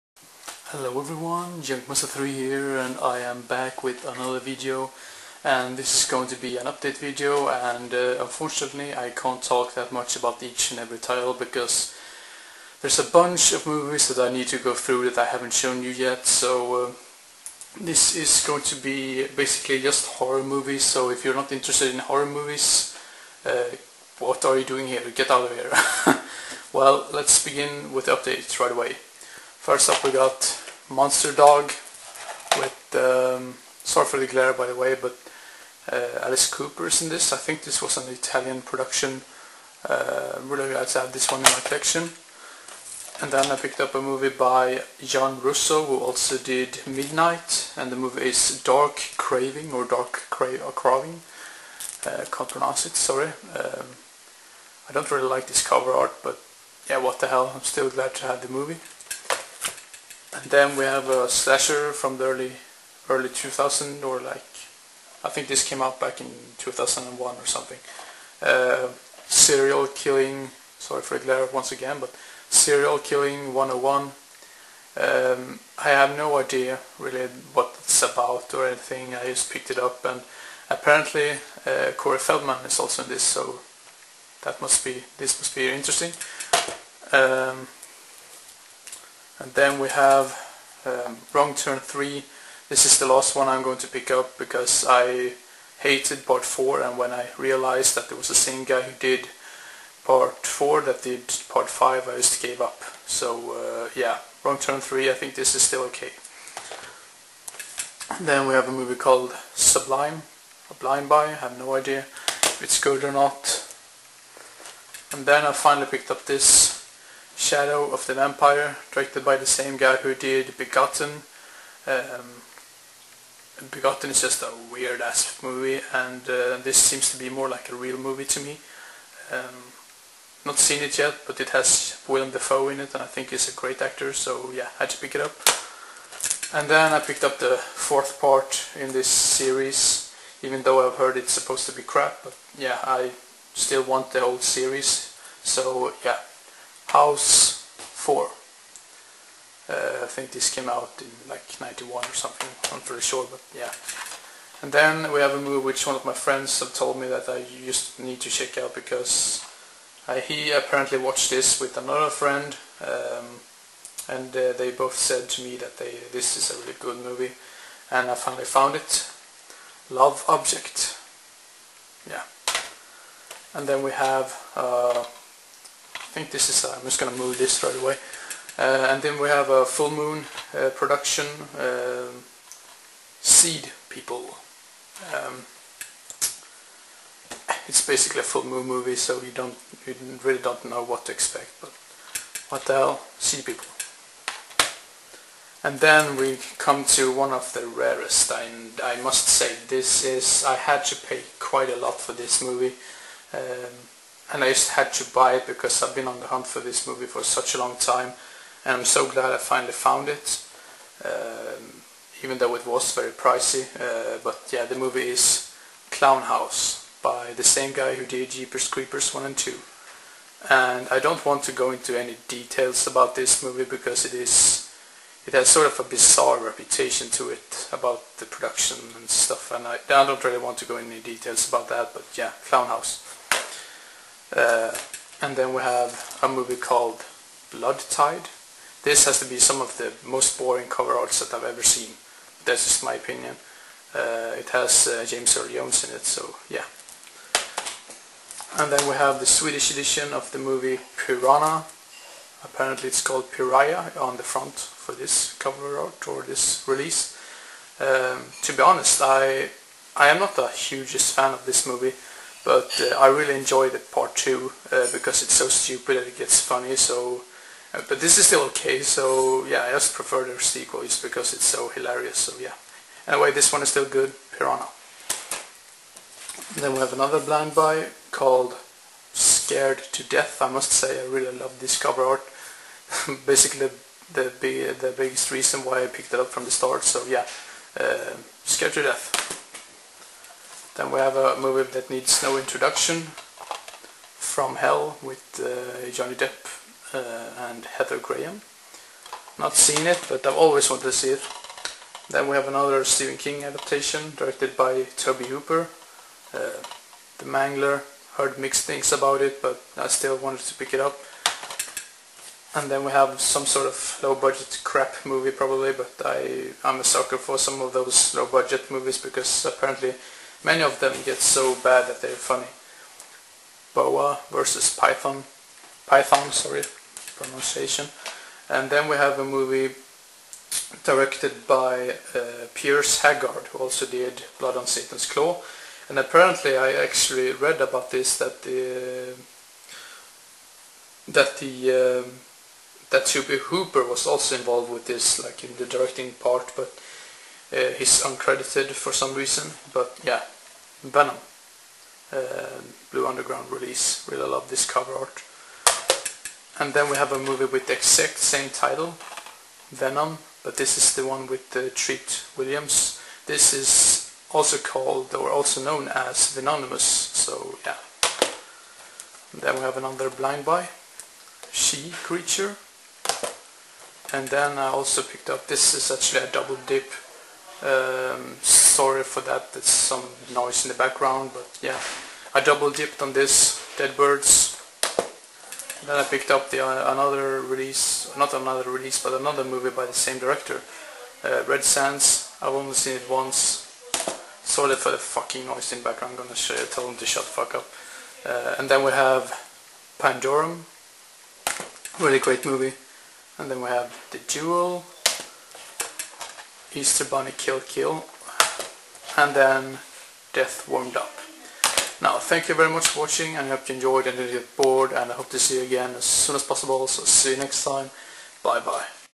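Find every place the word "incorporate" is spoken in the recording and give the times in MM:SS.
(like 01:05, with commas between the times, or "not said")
not said.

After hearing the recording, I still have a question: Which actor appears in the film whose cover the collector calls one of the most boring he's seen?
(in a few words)
James Earl Jones.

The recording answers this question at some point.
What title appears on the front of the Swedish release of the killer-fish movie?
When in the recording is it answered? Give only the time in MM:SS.
04:13.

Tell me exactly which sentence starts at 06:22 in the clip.
I double dipped on this, Dead Birds.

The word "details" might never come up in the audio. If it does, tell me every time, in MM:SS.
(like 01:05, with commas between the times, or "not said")
03:42, 03:50.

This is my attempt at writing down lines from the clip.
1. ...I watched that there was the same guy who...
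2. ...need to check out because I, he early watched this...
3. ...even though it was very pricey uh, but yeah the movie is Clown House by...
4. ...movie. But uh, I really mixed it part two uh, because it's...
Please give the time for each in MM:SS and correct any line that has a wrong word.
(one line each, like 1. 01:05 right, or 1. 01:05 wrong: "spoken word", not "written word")
1. 01:37 wrong: "realized", not "watched"
2. 02:37 wrong: "apparently", not "early"
3. 03:32 right
4. 04:21 wrong: "enjoyed", not "mixed".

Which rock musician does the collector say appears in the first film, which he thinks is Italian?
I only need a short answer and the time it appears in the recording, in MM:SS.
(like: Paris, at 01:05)
Alice Cooper, at 00:36.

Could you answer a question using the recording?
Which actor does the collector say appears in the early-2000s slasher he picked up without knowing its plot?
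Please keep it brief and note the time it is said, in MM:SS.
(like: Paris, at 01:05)
Corey Feldman, at 01:21.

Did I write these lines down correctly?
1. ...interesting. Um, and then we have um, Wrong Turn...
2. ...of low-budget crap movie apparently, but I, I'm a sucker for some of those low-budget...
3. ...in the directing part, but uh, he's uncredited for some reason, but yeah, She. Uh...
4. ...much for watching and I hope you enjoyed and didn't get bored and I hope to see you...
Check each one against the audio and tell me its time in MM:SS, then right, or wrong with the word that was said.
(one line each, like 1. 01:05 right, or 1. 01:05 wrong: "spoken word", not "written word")
1. 01:25 right
2. 05:13 wrong: "probably", not "apparently"
3. 05:45 wrong: "Venom", not "She"
4. 06:52 right.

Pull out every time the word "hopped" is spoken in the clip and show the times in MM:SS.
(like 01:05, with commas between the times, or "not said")
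not said.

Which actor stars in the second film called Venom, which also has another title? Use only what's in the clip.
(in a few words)
Treat Williams.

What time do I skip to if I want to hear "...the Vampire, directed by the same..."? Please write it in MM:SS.
01:58.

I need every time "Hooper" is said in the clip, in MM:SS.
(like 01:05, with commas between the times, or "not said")
05:05, 05:43.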